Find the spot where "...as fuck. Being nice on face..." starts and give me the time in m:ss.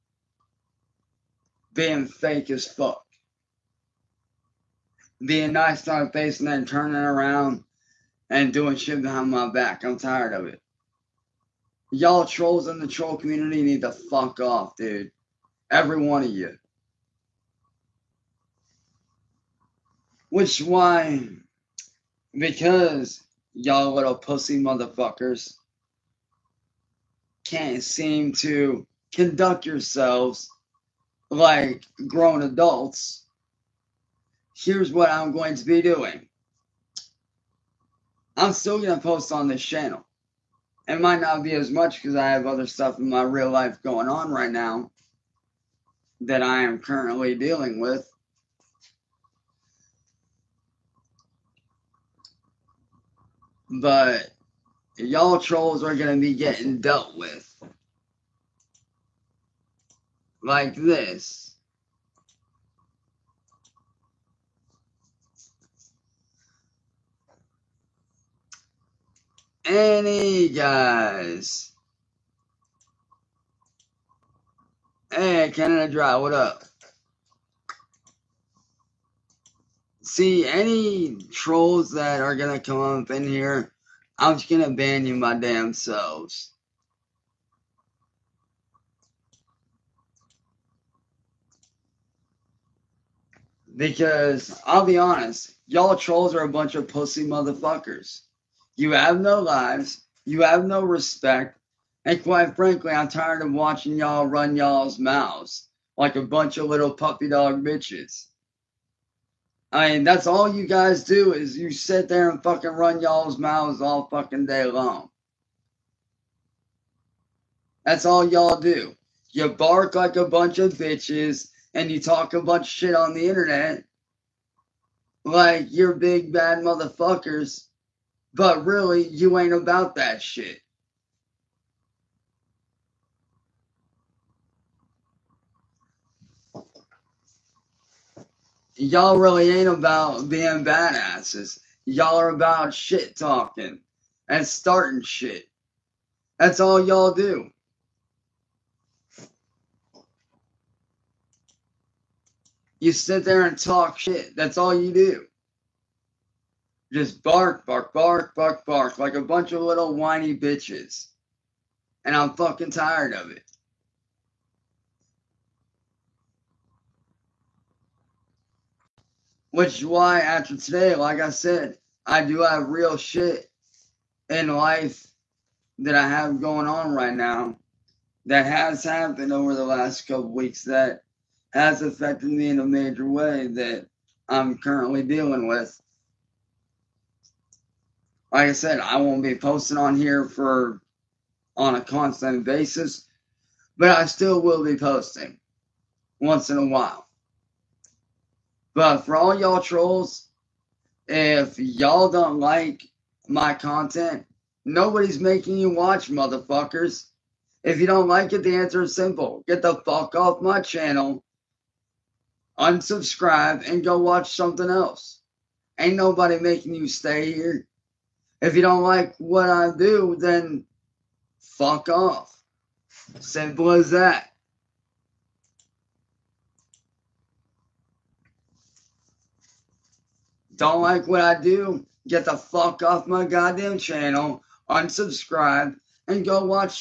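0:02.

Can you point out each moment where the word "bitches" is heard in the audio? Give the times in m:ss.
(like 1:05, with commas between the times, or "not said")
1:47, 2:00, 2:40.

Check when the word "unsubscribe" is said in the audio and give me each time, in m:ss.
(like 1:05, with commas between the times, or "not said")
3:32, 3:54.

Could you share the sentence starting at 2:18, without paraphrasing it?
Y'all really ain't about being badasses.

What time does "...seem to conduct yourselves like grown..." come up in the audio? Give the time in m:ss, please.
0:27.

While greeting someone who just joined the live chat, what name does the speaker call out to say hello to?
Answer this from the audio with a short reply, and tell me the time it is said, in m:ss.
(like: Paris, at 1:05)
Canada Dry, at 1:15.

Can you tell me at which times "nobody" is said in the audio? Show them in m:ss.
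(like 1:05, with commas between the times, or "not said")
3:24, 3:35.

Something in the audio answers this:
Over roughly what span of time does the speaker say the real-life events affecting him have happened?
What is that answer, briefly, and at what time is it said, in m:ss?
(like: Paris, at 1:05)
last couple weeks, at 2:59.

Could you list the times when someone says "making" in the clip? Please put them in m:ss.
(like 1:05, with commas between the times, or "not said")
3:25, 3:36.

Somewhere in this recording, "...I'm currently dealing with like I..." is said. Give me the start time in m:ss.
3:04.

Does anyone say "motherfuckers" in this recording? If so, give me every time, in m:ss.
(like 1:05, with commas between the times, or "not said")
0:24, 1:37, 2:06, 3:26.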